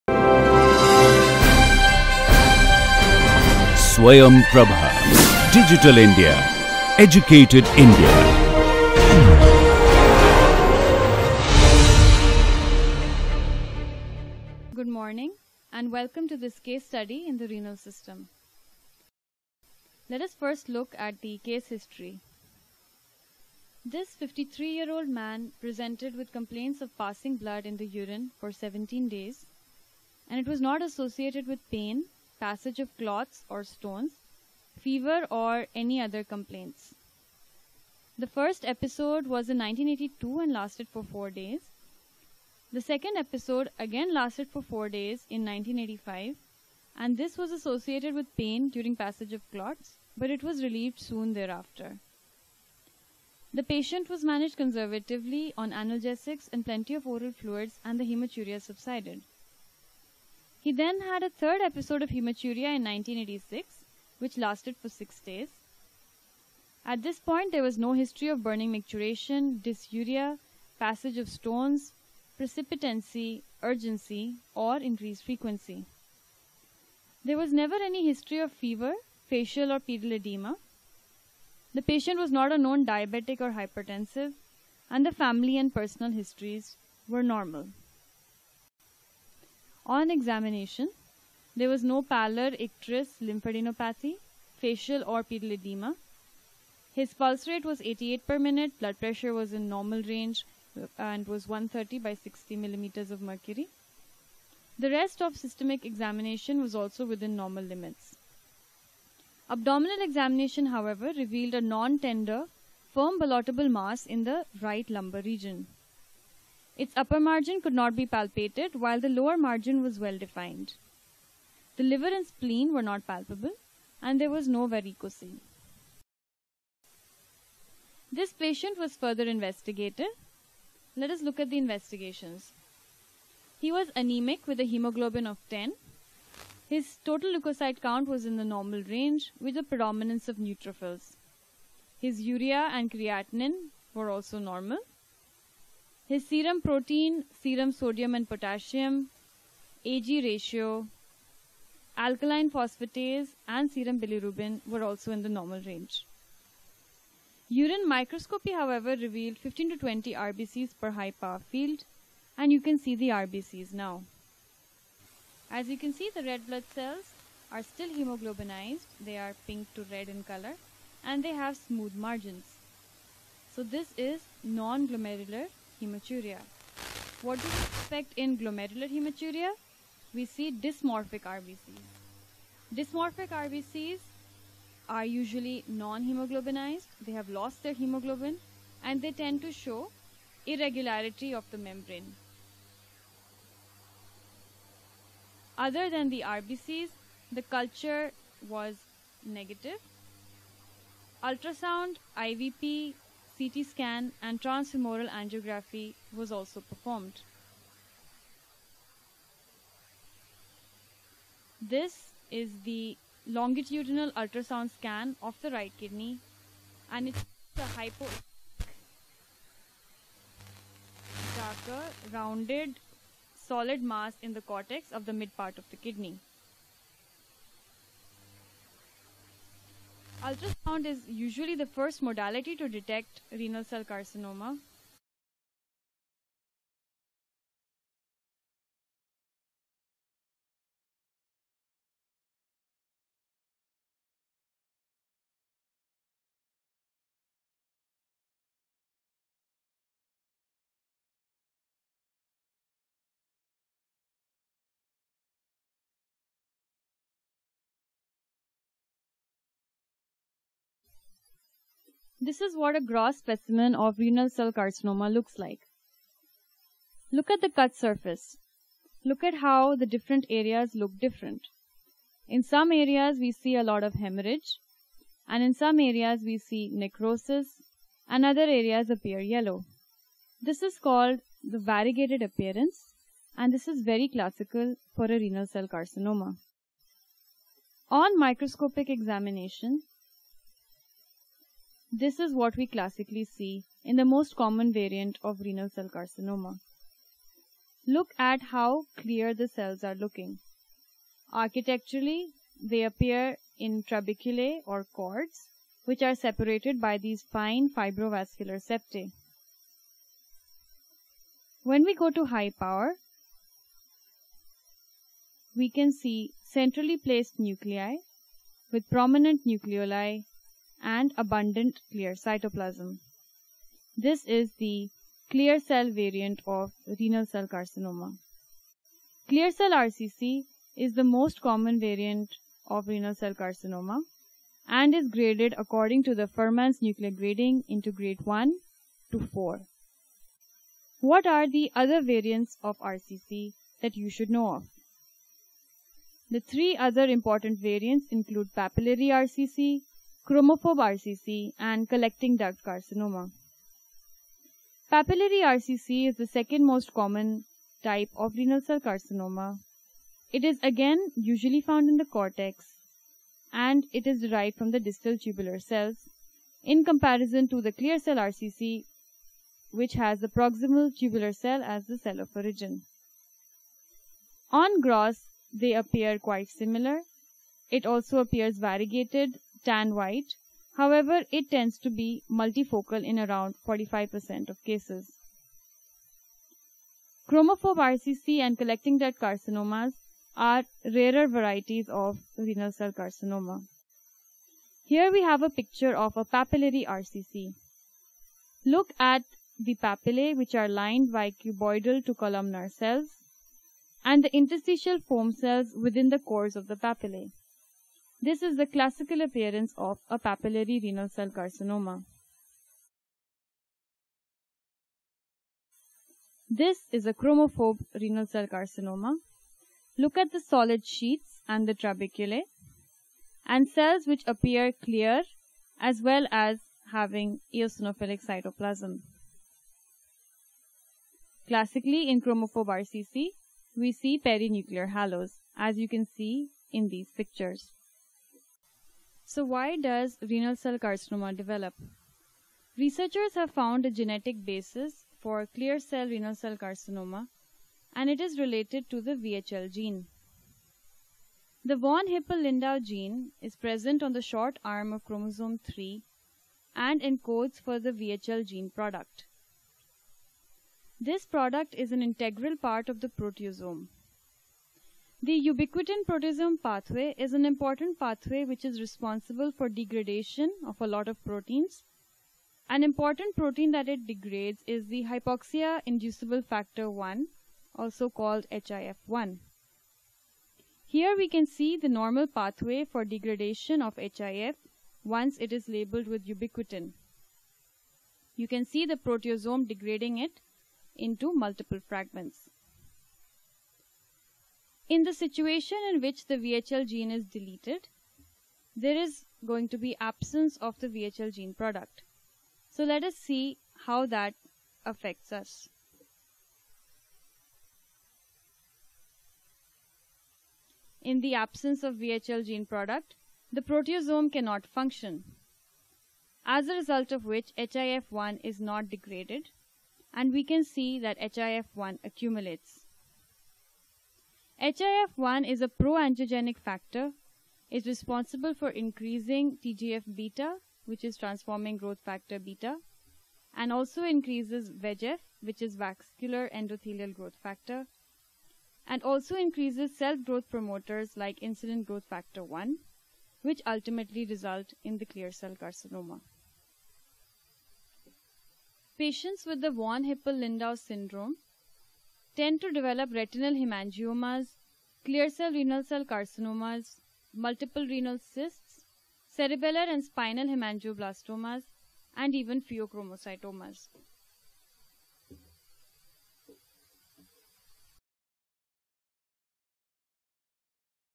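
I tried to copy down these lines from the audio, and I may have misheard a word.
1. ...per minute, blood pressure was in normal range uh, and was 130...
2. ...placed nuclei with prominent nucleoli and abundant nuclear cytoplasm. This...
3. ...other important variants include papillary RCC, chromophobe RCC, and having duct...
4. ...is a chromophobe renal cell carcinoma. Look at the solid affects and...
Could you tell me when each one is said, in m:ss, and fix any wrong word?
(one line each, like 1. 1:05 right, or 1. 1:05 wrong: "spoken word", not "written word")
1. 1:38 right
2. 5:16 wrong: "clear", not "nuclear"
3. 5:46 wrong: "collecting", not "having"
4. 6:56 wrong: "sheets", not "affects".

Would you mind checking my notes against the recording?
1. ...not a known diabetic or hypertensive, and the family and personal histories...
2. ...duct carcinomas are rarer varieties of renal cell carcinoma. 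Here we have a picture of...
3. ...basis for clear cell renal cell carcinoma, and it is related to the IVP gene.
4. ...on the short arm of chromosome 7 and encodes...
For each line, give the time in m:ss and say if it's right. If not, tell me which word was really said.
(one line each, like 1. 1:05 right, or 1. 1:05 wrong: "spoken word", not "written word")
1. 1:22 right
2. 6:28 right
3. 7:24 wrong: "VHL", not "IVP"
4. 7:34 wrong: "3", not "7".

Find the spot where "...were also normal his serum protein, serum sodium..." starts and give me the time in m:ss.
2:23.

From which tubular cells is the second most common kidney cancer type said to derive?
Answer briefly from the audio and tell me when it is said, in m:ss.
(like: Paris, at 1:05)
Distal tubular cells, at 6:04.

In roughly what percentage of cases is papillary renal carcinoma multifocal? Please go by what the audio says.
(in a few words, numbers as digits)
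45%.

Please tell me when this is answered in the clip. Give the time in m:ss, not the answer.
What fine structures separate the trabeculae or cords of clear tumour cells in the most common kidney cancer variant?
5:07.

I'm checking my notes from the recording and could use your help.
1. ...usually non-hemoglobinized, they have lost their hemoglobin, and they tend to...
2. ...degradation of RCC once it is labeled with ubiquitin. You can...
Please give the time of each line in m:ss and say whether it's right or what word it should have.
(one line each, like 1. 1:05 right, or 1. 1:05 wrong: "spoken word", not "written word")
1. 3:05 right
2. 8:03 wrong: "HIF", not "RCC".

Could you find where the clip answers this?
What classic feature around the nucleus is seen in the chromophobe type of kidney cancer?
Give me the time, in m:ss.
7:14.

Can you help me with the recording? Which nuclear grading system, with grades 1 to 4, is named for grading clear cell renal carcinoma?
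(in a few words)
Fuhrman's nuclear grading.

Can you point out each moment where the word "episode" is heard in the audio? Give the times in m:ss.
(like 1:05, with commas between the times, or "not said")
0:38, 0:43, 1:01.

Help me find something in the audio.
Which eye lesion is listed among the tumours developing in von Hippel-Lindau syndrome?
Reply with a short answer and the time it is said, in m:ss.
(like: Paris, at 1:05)
Retinal hemangiomas, at 9:13.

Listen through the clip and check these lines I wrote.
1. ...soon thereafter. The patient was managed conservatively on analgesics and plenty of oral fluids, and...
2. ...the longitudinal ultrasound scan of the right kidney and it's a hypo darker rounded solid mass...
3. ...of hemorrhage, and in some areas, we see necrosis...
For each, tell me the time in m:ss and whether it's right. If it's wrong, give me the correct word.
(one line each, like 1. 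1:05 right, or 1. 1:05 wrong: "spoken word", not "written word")
1. 0:50 right
2. 3:32 right
3. 4:33 right.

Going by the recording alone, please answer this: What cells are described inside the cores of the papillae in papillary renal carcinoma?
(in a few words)
Interstitial foam cells.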